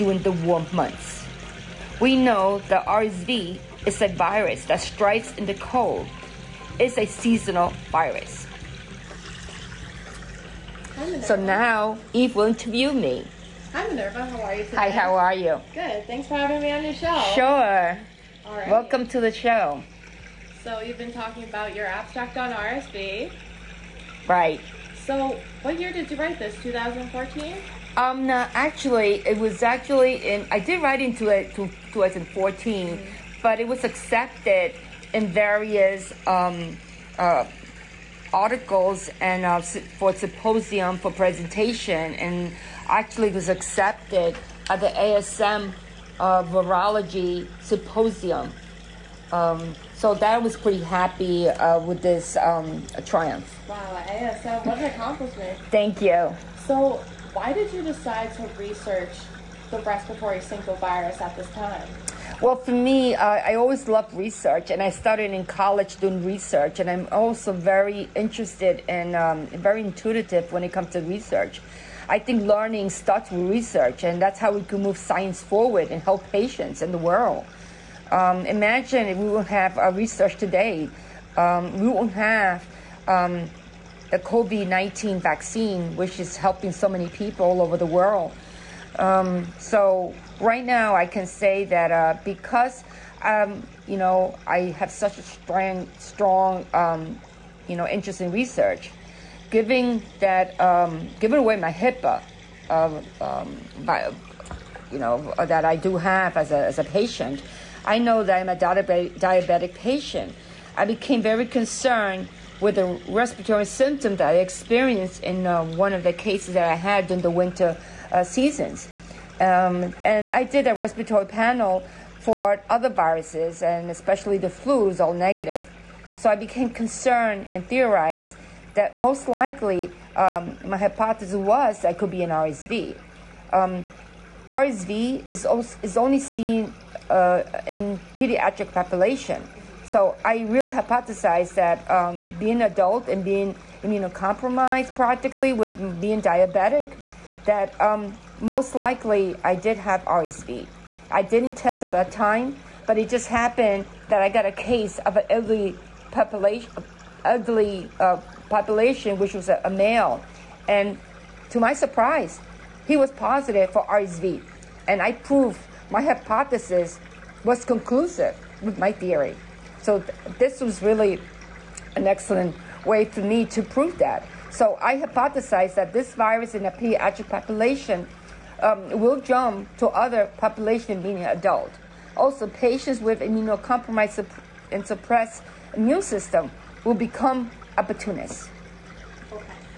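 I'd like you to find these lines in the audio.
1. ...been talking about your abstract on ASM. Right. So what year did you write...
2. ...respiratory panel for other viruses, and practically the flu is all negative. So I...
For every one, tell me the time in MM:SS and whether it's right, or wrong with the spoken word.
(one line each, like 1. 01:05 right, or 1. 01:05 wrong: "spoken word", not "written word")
1. 00:20 wrong: "RSV", not "ASM"
2. 02:00 wrong: "especially", not "practically".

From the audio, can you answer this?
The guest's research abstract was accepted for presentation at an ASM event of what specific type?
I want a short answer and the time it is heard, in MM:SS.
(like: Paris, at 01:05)
virology symposium, at 00:46.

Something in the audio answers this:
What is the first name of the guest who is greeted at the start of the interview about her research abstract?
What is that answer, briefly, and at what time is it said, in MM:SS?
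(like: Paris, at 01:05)
Minerva, at 00:13.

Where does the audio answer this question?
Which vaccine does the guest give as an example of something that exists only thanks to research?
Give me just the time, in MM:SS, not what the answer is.
01:24.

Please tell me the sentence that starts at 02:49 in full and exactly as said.
So th- this was really an excellent way for me to prove that.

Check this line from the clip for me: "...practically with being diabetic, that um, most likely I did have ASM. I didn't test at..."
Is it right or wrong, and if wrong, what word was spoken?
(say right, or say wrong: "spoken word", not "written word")
wrong: "RSV", not "ASM".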